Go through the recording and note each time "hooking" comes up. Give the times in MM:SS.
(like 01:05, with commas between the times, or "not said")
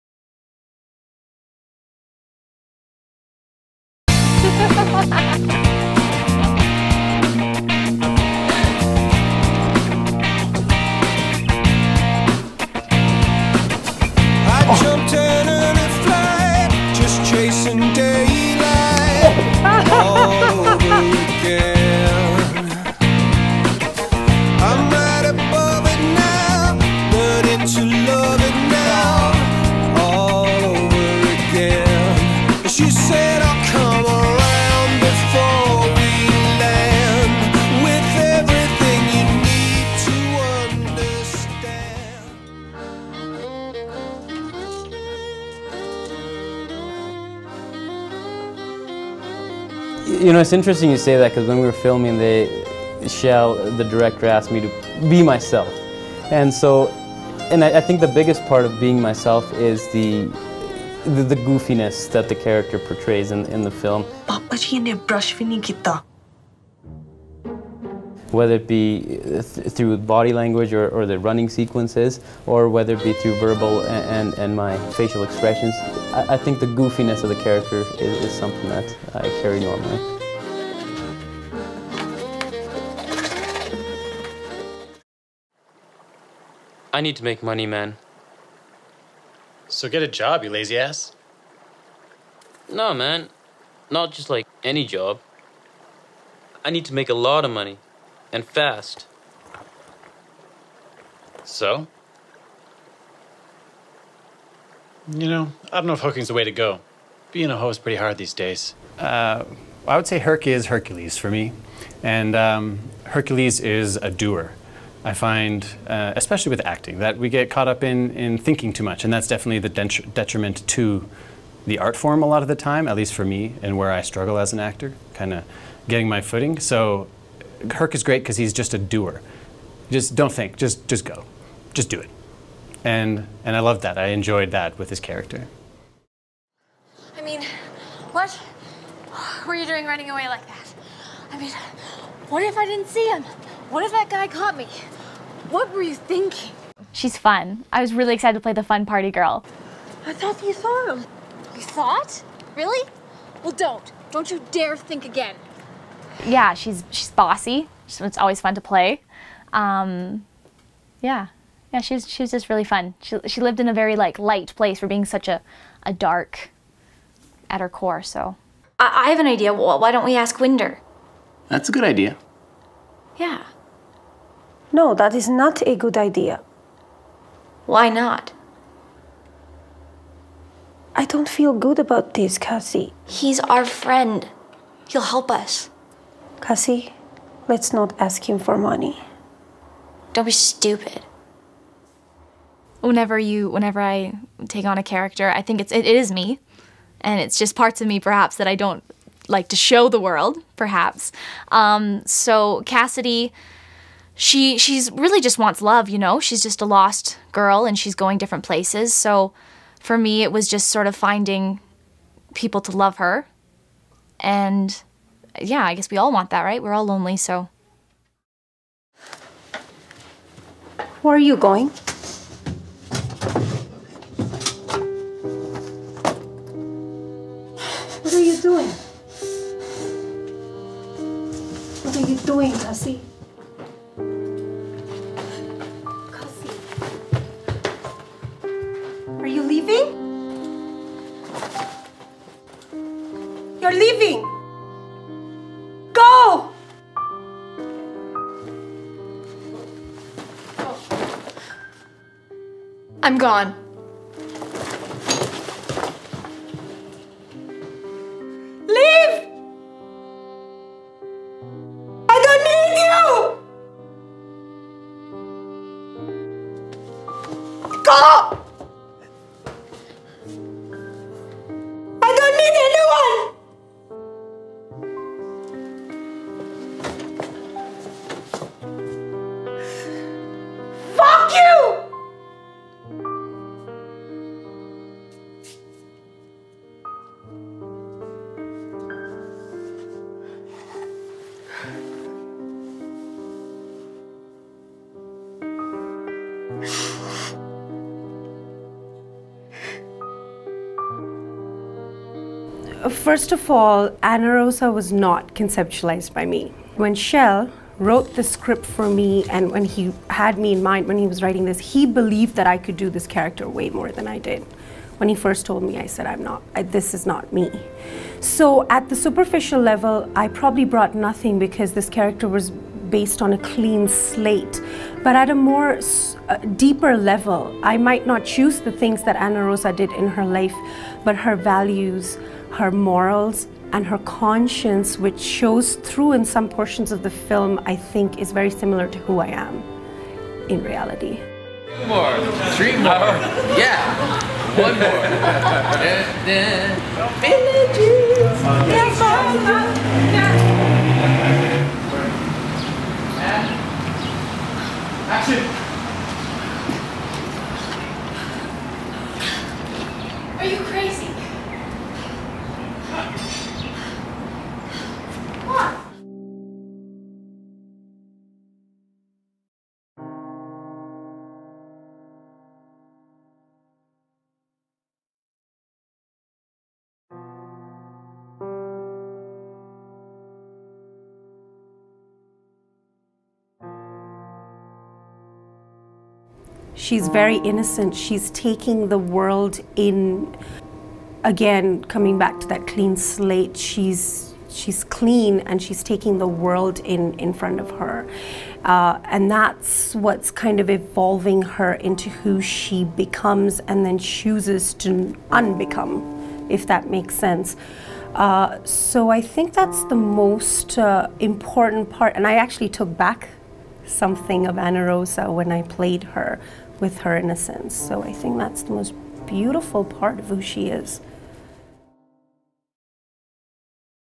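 01:45.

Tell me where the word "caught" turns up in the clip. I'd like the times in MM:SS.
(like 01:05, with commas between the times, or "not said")
01:57, 02:24.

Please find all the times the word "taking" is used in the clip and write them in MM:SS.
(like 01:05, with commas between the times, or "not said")
06:28, 06:35.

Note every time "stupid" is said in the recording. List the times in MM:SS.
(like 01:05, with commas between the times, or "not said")
03:10.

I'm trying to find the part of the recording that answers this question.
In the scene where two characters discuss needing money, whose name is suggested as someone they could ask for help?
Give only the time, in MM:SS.
02:50.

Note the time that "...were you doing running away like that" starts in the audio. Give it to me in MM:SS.
02:19.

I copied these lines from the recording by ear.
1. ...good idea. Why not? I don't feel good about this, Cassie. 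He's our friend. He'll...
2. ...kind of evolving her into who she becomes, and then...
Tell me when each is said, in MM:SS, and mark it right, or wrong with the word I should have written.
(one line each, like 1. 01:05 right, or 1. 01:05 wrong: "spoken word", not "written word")
1. 02:55 right
2. 06:40 right.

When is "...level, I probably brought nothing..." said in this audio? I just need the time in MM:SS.
05:19.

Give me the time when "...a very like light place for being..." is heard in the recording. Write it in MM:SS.
02:43.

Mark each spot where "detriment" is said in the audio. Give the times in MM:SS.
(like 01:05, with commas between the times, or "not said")
02:00.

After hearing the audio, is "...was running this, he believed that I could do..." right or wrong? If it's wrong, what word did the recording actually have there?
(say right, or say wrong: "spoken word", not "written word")
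wrong: "writing", not "running".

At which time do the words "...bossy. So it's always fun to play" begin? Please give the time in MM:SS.
02:37.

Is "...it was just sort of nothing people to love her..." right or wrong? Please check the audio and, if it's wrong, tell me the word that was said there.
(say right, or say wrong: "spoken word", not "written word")
wrong: "finding", not "nothing".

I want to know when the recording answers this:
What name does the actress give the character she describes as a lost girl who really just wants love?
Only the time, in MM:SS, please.
03:22.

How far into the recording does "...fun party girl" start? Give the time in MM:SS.
02:28.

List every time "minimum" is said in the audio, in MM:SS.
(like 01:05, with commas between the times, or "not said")
not said.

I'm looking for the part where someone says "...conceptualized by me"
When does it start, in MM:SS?
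05:05.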